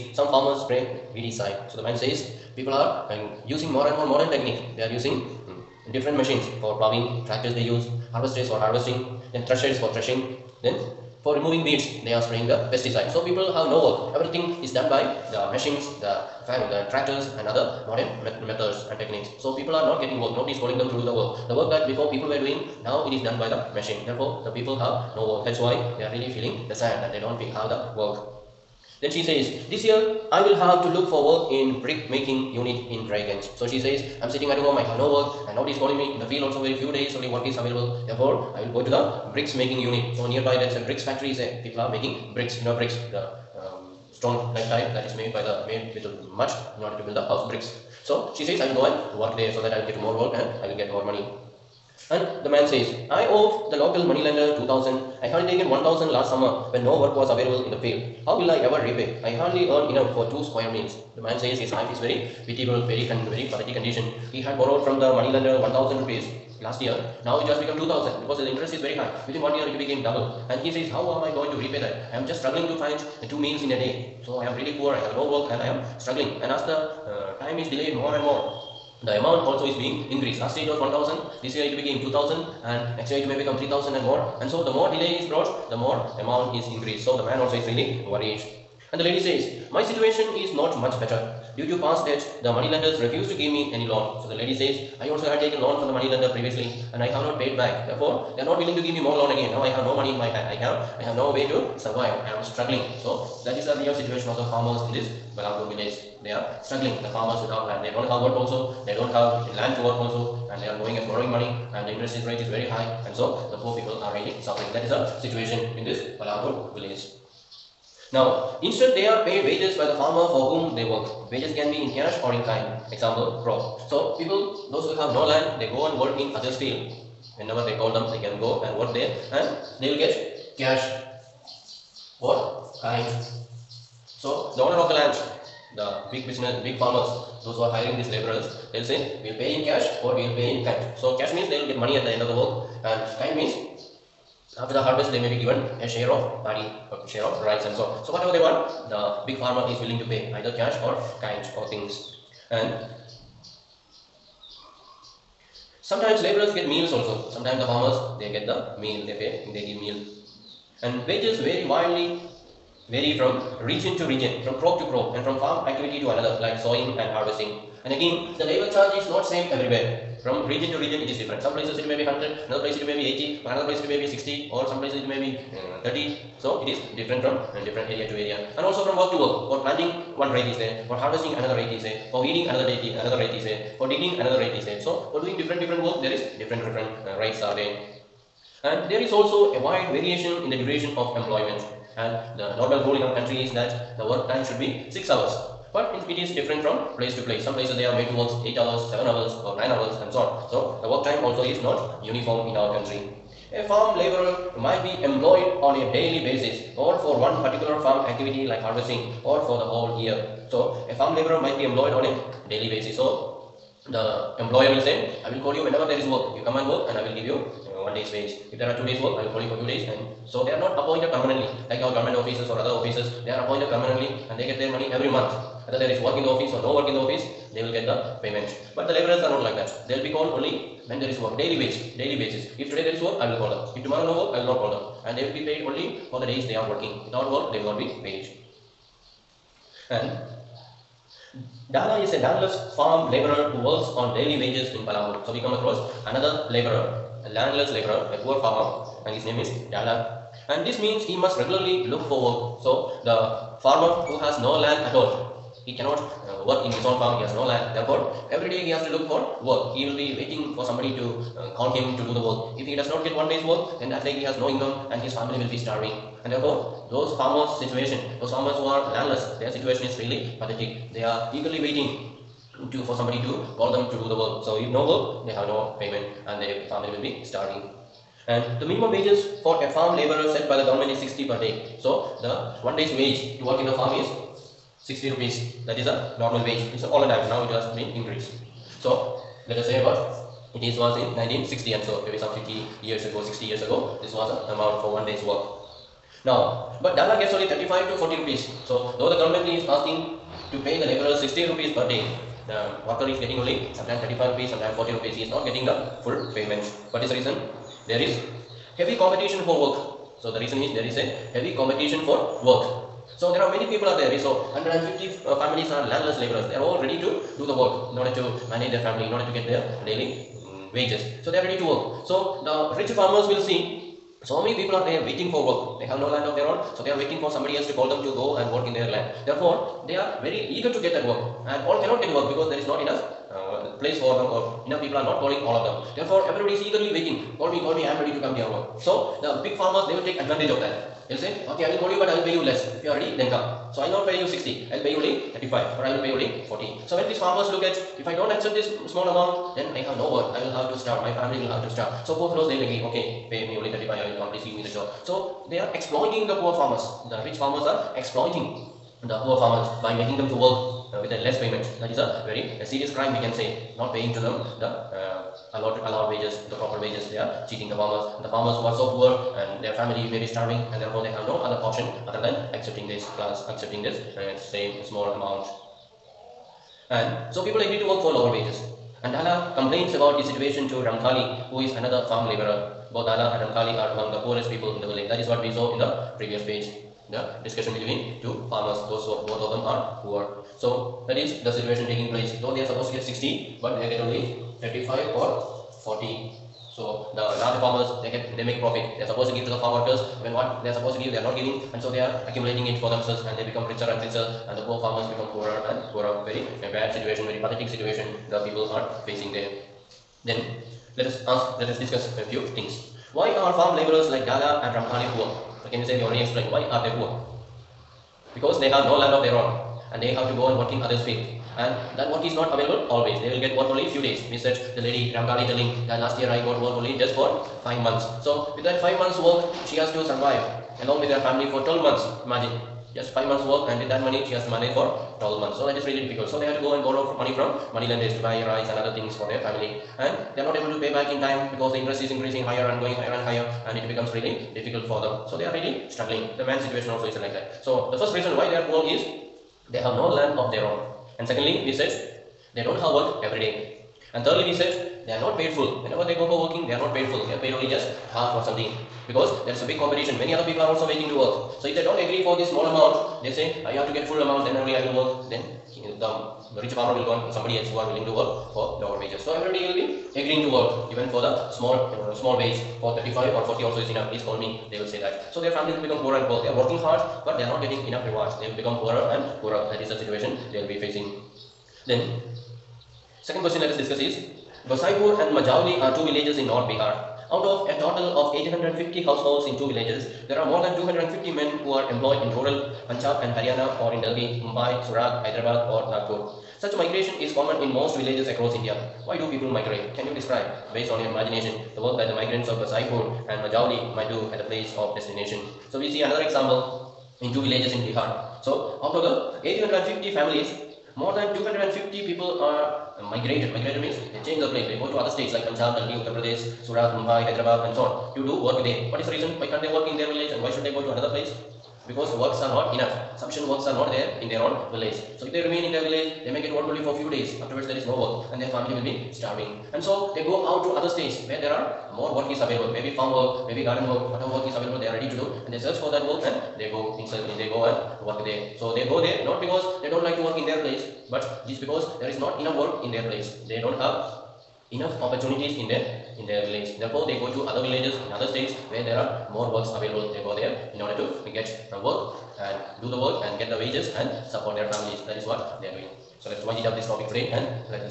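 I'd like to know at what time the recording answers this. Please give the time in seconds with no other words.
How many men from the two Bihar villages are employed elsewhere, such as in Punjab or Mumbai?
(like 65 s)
490 s.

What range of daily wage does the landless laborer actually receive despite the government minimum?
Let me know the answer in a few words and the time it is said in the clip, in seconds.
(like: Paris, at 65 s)
35 to 40 rupees, at 297 s.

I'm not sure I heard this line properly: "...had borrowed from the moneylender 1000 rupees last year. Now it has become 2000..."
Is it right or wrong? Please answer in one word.
right.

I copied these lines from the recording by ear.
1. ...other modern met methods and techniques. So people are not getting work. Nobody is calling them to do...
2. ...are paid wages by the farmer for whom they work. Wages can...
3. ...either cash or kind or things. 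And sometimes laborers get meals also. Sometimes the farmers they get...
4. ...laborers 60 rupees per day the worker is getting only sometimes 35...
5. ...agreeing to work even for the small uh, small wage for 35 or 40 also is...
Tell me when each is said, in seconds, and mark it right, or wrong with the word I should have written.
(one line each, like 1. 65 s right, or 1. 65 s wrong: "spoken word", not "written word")
1. 17 s right
2. 119 s right
3. 150 s right
4. 300 s right
5. 470 s right.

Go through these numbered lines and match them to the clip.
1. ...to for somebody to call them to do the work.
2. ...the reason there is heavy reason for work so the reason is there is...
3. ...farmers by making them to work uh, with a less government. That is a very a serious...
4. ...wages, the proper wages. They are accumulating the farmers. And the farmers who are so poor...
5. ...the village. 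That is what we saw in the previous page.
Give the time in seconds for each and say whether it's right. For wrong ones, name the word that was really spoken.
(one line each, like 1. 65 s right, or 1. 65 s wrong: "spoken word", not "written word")
1. 272 s right
2. 307 s wrong: "competition", not "reason"
3. 359 s wrong: "payment", not "government"
4. 366 s wrong: "cheating", not "accumulating"
5. 384 s right.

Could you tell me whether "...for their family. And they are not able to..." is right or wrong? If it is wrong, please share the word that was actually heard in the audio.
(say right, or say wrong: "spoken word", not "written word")
right.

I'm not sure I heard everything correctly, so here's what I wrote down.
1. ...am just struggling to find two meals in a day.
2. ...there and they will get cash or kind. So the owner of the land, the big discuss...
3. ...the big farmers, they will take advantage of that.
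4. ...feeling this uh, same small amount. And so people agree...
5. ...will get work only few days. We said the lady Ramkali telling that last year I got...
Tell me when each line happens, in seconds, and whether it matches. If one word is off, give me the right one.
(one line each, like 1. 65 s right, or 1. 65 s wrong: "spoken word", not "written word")
1. 72 s right
2. 128 s wrong: "business", not "discuss"
3. 339 s right
4. 373 s wrong: "accepting", not "feeling"
5. 423 s right.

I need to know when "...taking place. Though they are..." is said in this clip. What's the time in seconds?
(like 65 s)
391 s.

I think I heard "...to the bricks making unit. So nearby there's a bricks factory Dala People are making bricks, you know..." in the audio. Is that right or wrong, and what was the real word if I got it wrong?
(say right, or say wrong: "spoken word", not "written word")
wrong: "Say", not "Dala".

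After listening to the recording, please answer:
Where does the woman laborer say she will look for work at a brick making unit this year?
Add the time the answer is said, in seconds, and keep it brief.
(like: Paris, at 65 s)
Raiganj, at 33 s.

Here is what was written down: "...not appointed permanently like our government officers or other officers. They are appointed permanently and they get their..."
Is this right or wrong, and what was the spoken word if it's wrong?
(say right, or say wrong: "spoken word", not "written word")
right.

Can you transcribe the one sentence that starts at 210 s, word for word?
So a farm laborer might be employed on a daily basis.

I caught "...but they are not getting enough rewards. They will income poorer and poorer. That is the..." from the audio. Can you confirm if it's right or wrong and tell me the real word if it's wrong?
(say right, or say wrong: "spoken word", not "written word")
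wrong: "become", not "income".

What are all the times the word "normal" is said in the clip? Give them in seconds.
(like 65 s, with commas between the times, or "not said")
192 s, 286 s.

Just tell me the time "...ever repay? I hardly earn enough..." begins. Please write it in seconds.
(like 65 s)
58 s.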